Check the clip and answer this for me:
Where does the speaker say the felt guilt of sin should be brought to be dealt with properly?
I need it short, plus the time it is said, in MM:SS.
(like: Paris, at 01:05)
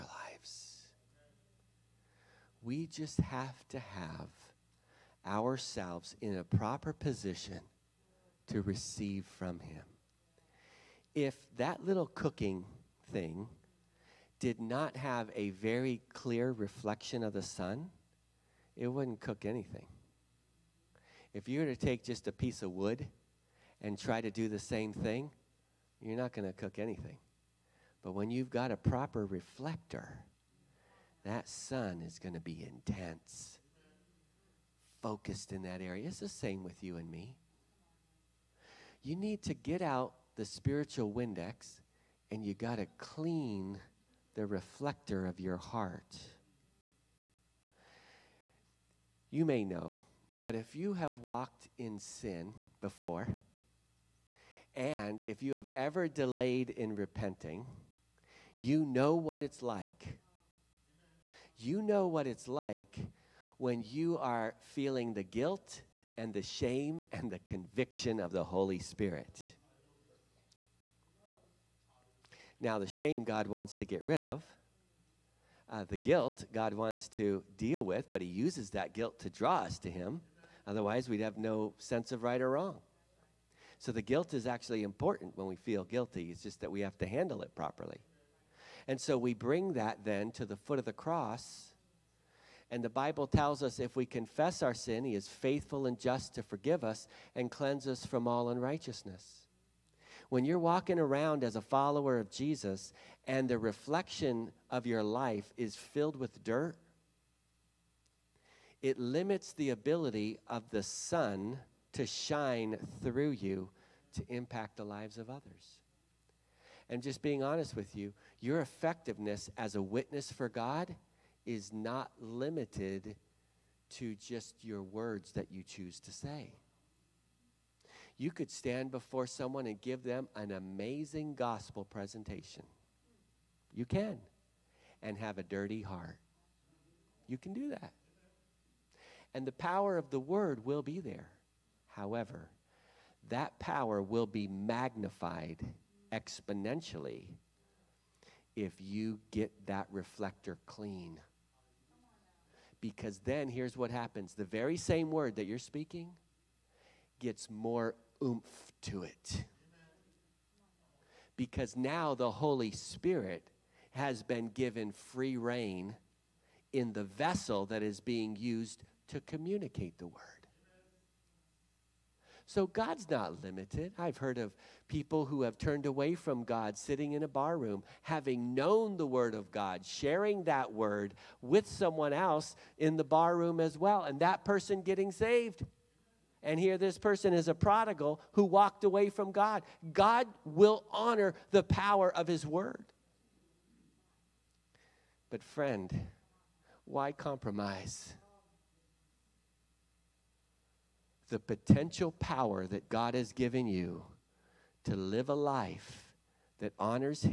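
The foot of the cross, at 01:30.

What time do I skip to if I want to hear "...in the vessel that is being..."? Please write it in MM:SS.
02:46.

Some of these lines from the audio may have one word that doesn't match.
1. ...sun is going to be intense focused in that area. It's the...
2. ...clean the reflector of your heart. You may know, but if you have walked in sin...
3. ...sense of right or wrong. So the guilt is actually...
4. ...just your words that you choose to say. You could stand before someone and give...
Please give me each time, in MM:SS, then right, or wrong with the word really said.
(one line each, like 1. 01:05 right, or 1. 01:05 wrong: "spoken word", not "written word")
1. 00:31 right
2. 00:42 right
3. 01:21 right
4. 02:04 right.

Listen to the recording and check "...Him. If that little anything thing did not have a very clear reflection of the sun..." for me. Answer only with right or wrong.
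wrong.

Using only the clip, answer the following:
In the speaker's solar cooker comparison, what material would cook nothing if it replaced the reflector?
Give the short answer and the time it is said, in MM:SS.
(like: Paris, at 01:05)
A piece of wood, at 00:22.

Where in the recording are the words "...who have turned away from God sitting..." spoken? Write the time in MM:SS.
02:55.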